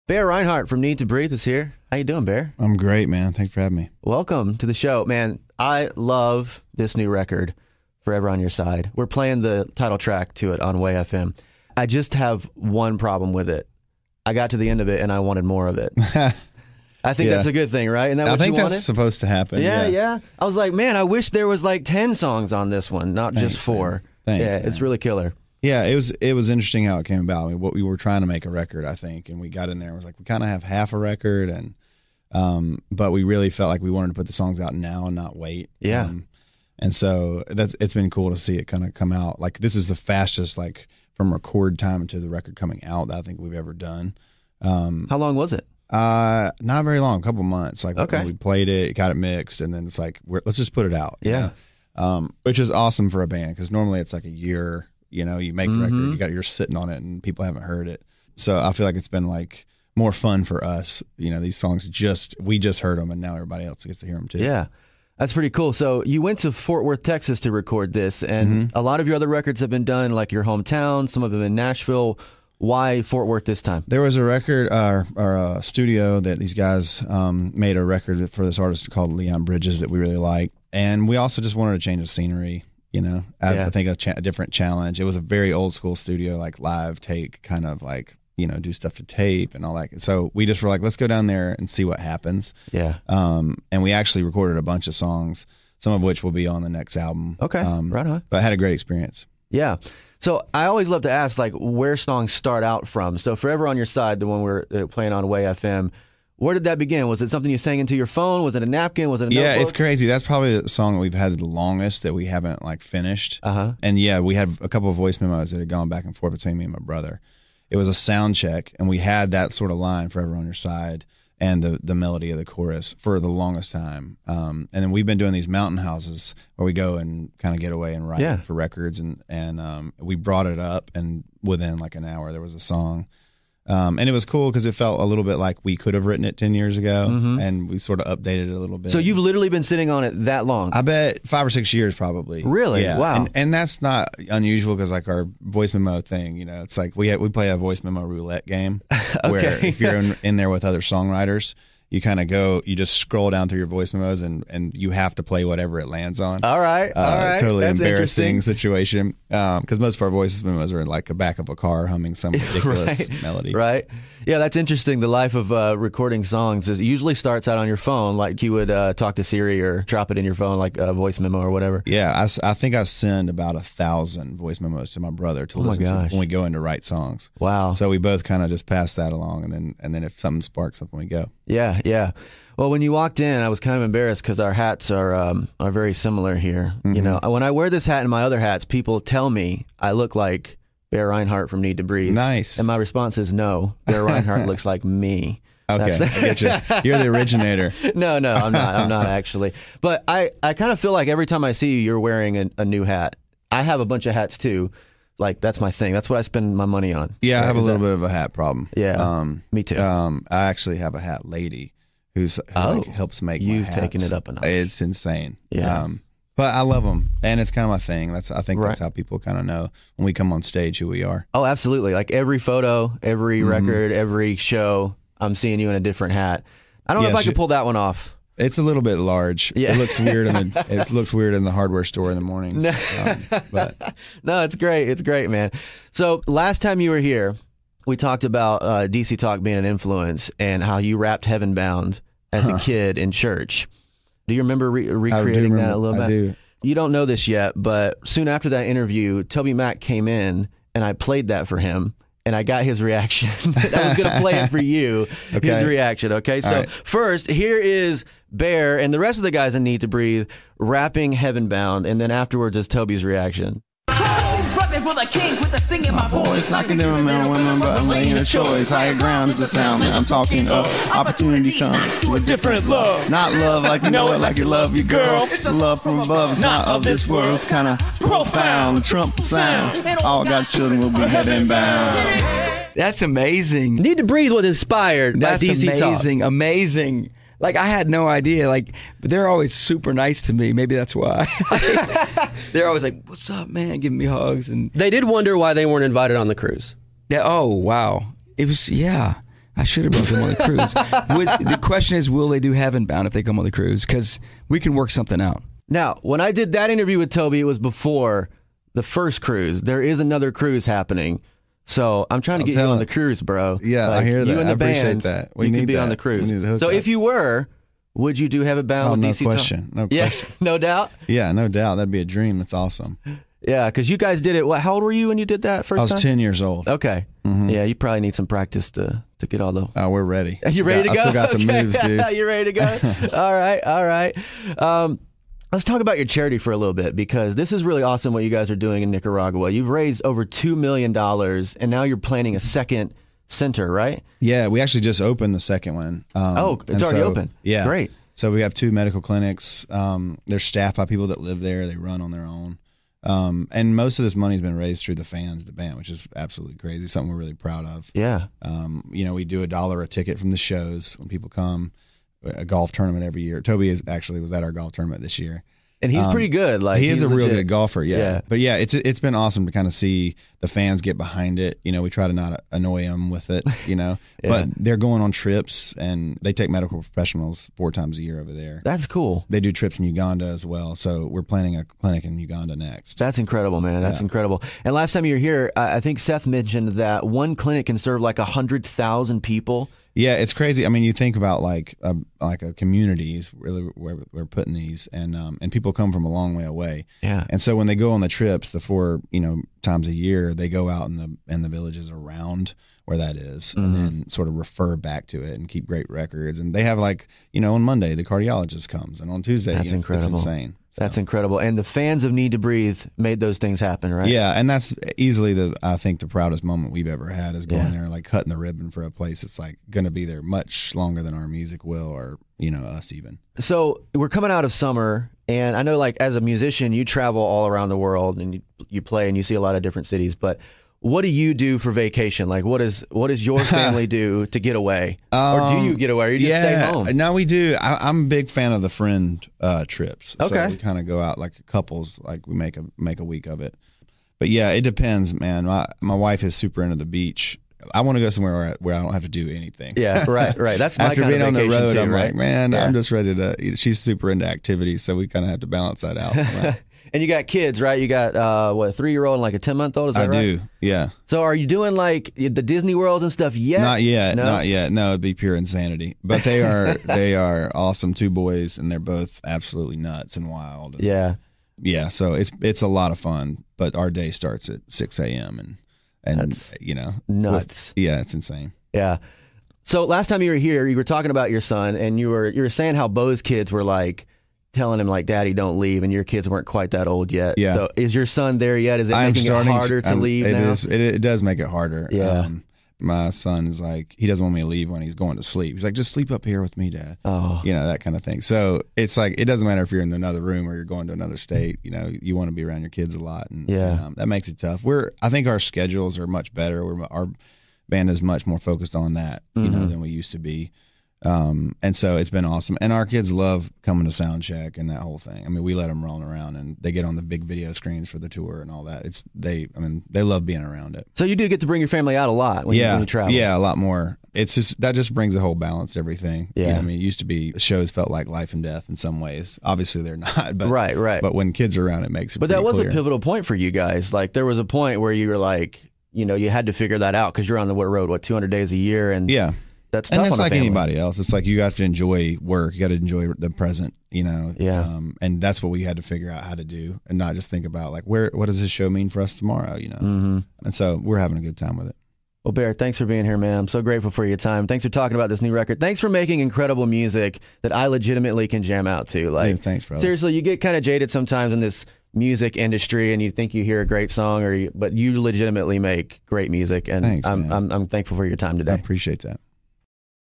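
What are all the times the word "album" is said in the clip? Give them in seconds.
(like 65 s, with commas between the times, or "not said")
96 s.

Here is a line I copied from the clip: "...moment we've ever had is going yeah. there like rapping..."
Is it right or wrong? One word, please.
wrong.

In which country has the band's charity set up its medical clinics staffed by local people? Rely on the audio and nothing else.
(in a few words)
Nicaragua.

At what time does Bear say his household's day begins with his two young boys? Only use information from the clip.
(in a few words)
6 a.m.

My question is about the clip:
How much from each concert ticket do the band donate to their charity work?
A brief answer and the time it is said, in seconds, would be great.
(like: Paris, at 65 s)
a dollar, at 359 s.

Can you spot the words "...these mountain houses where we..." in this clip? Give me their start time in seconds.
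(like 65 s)
125 s.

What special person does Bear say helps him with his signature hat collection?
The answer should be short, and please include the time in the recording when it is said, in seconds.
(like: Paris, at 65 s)
a hat lady, at 210 s.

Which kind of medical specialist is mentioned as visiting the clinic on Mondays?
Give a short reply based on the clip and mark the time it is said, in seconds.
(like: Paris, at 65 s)
cardiologist, at 408 s.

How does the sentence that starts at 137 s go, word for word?
and we sort of updated it a little bit.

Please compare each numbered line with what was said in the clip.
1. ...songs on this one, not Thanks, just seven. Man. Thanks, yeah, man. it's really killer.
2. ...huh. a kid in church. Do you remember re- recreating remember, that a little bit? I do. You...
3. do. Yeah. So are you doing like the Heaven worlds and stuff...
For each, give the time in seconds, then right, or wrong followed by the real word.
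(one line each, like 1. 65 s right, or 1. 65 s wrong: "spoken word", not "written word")
1. 22 s wrong: "four", not "seven"
2. 242 s right
3. 460 s wrong: "Disney", not "Heaven".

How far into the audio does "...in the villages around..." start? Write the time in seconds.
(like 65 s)
401 s.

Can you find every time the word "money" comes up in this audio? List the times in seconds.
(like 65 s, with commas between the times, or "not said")
206 s, 354 s.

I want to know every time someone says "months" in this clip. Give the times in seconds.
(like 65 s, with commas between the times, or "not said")
47 s, 459 s.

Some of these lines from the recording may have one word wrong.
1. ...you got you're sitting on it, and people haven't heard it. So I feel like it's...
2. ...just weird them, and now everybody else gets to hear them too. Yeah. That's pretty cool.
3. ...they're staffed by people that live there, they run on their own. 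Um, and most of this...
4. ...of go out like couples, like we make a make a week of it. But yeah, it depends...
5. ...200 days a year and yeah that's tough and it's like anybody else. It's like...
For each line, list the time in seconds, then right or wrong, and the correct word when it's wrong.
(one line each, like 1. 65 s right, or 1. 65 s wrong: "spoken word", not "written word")
1. 56 s right
2. 62 s wrong: "heard", not "weird"
3. 350 s right
4. 440 s right
5. 538 s right.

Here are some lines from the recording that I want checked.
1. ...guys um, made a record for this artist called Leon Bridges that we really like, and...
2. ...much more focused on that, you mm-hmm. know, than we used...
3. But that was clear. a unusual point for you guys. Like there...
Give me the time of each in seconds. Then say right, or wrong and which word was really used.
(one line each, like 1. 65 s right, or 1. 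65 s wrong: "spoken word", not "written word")
1. 76 s right
2. 508 s right
3. 532 s wrong: "pivotal", not "unusual".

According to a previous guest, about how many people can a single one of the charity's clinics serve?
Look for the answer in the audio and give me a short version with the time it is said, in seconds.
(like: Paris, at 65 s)
100,000, at 388 s.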